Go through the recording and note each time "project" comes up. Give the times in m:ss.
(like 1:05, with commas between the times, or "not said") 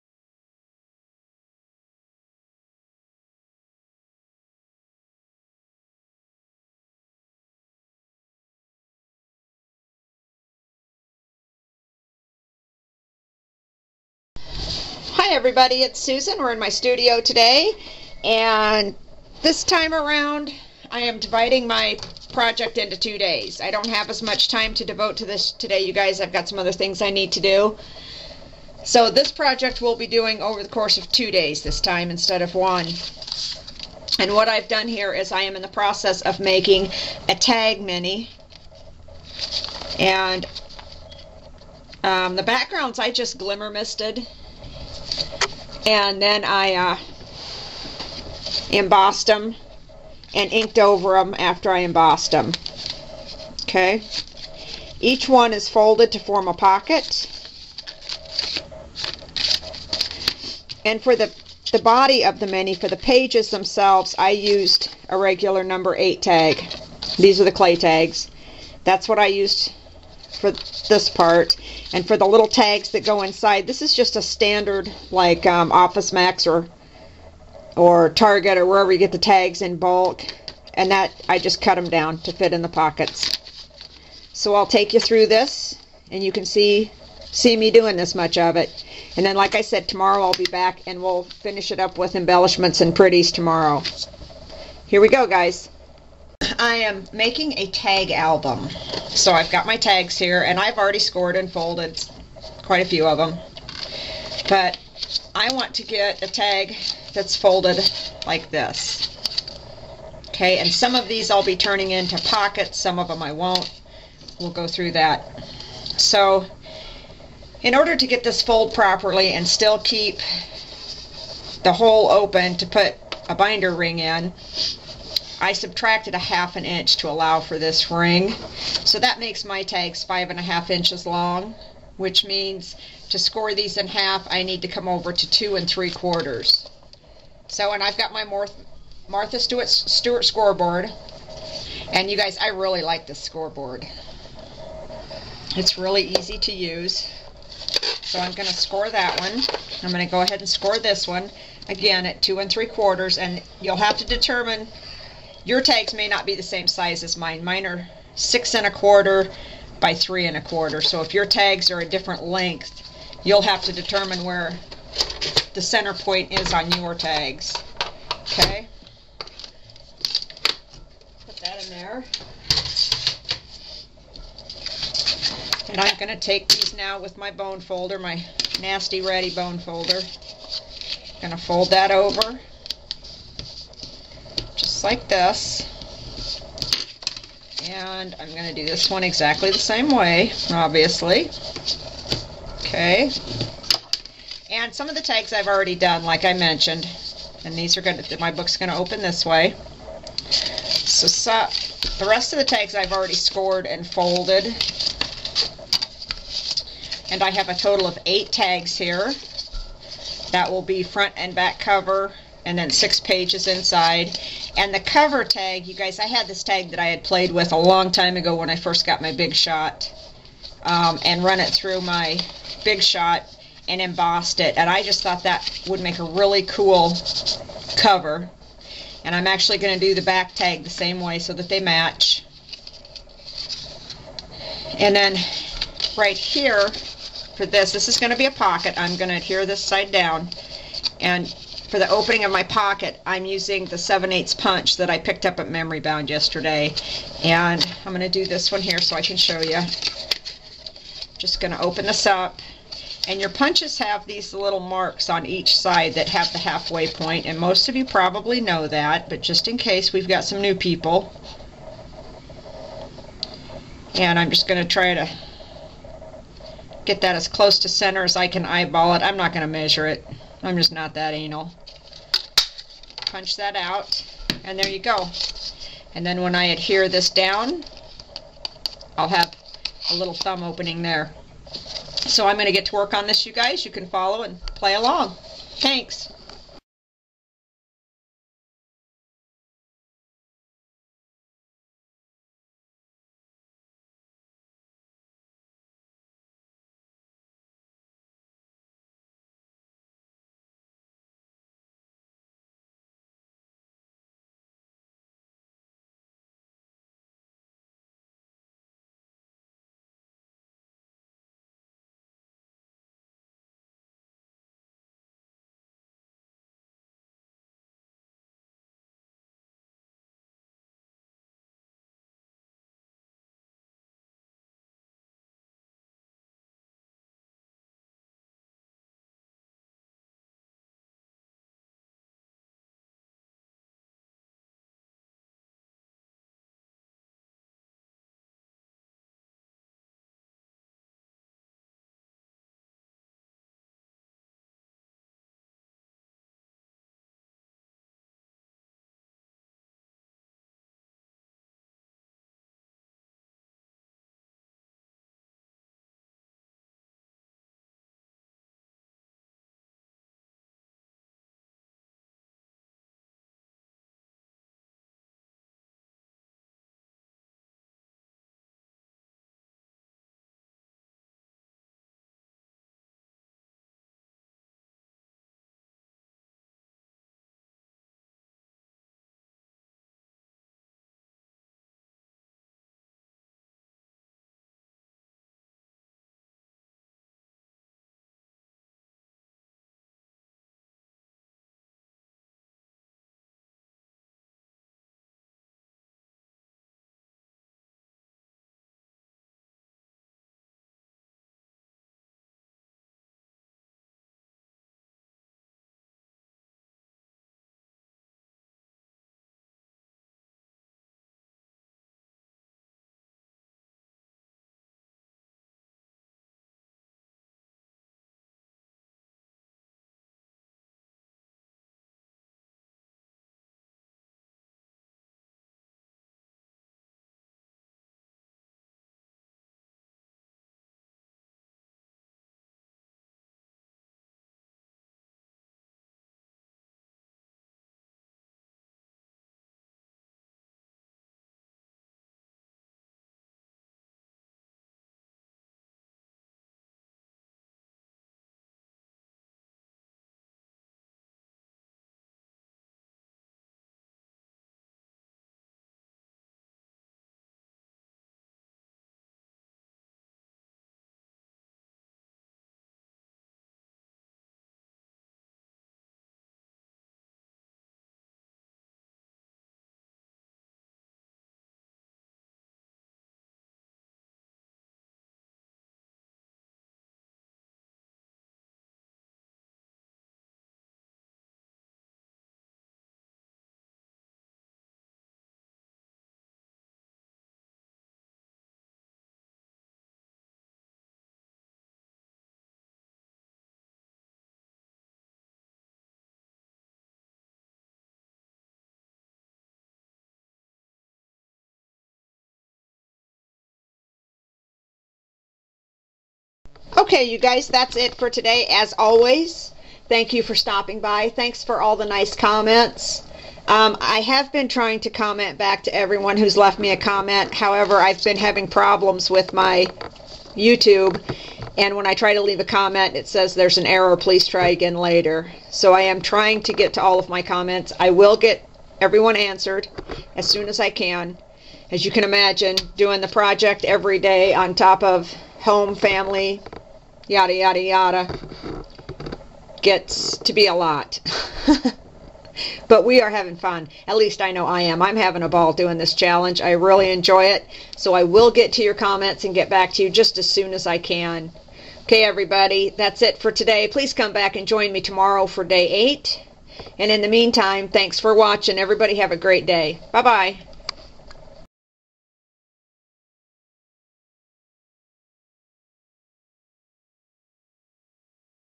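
0:22, 0:29, 8:53.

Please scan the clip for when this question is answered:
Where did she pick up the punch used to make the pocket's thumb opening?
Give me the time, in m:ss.
4:05.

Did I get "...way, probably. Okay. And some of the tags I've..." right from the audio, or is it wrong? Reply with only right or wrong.
wrong.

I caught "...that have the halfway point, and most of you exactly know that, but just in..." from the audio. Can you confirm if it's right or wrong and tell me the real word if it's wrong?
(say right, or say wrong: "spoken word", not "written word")
wrong: "probably", not "exactly".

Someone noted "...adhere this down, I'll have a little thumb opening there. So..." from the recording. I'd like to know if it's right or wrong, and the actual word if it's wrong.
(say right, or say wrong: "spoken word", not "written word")
right.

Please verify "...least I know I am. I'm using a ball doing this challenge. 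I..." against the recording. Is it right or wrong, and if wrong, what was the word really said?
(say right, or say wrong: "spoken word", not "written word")
wrong: "having", not "using".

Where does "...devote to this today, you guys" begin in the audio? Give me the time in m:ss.
0:24.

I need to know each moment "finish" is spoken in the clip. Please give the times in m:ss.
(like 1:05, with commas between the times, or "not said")
1:31.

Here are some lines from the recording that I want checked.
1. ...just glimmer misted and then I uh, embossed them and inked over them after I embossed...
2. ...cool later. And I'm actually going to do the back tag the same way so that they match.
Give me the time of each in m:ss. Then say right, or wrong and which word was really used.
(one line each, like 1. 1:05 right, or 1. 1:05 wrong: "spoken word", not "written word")
1. 0:43 right
2. 3:46 wrong: "cover", not "later".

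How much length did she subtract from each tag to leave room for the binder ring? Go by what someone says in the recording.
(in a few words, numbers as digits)
Half an inch.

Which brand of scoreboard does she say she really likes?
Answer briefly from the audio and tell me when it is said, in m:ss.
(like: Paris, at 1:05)
Martha Stewart, at 2:19.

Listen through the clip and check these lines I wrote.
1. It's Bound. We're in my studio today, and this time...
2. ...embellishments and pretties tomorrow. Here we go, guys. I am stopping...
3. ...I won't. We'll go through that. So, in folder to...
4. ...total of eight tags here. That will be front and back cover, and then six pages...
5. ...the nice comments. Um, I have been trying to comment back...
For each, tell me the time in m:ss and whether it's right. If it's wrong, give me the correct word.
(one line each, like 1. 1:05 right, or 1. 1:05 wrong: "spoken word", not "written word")
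1. 0:15 wrong: "Susan", not "Bound"
2. 1:32 wrong: "making", not "stopping"
3. 1:53 wrong: "order", not "folder"
4. 3:27 right
5. 8:31 right.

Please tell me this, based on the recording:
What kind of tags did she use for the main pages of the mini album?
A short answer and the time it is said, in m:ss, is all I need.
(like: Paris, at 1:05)
Clay tags, at 1:07.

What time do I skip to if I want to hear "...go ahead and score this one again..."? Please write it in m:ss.
2:30.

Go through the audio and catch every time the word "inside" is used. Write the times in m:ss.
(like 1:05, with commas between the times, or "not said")
1:13, 3:33.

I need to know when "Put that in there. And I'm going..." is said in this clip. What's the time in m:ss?
2:51.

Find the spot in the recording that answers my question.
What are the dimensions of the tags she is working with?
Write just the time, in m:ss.
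2:38.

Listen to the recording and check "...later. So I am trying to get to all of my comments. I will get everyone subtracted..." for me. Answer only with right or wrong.
wrong.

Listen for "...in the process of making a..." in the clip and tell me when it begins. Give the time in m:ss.
0:35.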